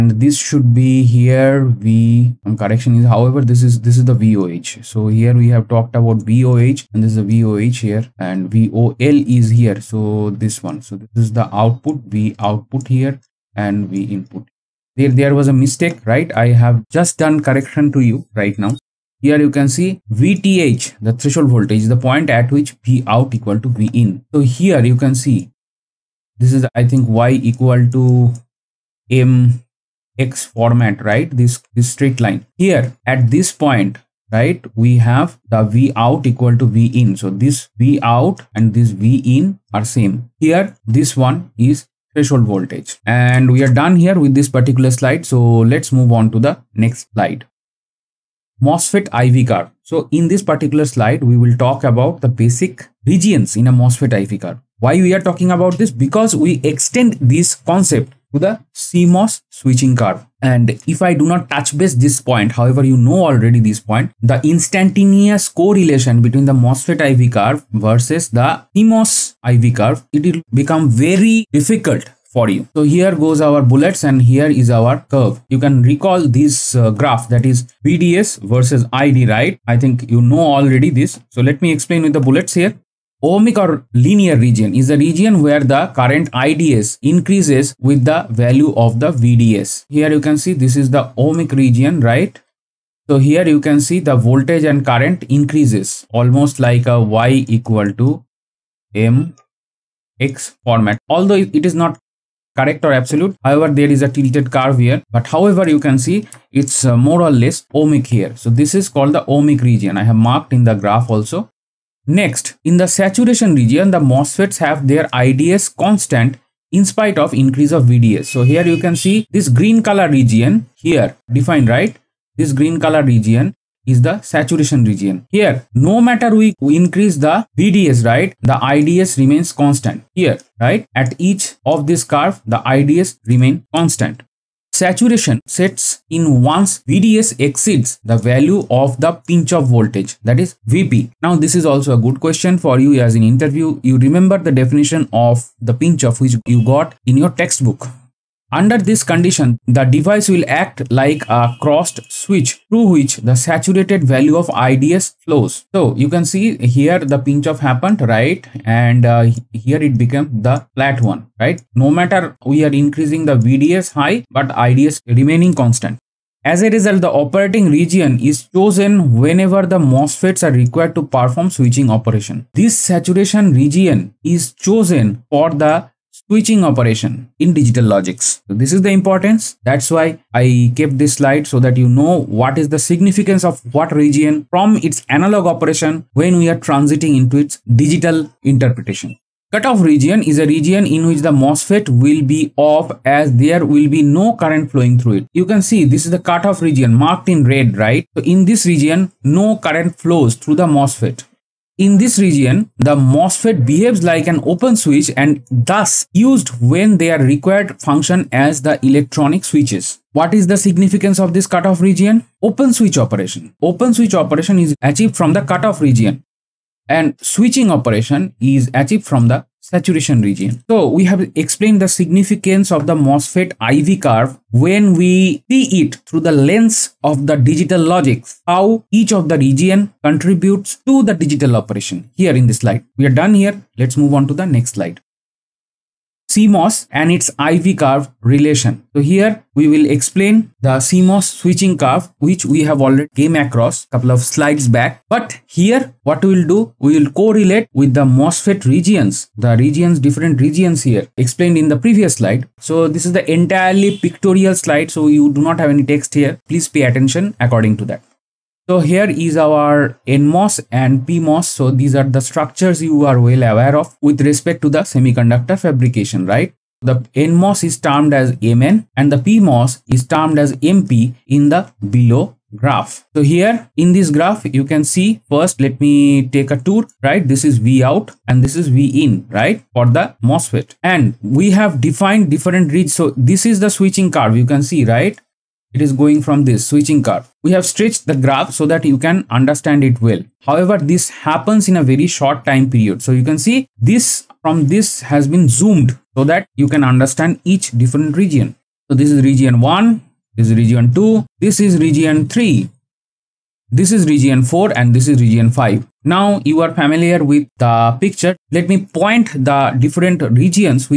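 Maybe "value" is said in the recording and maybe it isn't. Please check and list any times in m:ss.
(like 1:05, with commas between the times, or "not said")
1:28, 2:18, 2:34.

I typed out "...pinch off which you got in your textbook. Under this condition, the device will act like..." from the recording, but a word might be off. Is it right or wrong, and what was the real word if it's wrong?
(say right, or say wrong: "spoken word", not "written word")
right.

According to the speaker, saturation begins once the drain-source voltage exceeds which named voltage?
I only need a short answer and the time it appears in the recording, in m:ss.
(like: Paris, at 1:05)
Pinch off voltage, at 2:19.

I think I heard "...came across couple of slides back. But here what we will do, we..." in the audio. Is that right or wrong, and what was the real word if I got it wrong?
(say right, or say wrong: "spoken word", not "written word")
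right.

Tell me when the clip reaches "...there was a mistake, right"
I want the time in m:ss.
0:15.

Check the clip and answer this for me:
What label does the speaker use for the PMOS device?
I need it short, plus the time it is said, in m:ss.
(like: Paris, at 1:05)
MP, at 4:30.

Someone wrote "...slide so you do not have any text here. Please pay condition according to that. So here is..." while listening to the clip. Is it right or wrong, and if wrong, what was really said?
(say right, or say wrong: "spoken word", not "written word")
wrong: "attention", not "condition".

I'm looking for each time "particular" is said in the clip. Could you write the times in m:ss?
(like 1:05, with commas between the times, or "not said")
0:44, 0:50.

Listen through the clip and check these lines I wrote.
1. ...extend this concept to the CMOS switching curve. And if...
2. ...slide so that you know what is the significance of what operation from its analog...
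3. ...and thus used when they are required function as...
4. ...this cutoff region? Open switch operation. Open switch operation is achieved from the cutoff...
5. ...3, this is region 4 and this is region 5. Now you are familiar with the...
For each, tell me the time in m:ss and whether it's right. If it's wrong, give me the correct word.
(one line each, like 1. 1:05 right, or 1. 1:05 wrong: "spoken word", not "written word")
1. 0:56 right
2. 3:01 wrong: "region", not "operation"
3. 3:25 right
4. 3:31 right
5. 5:02 right.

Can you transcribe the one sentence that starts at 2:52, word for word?
This saturation region is chosen for the switching operation in digital logics.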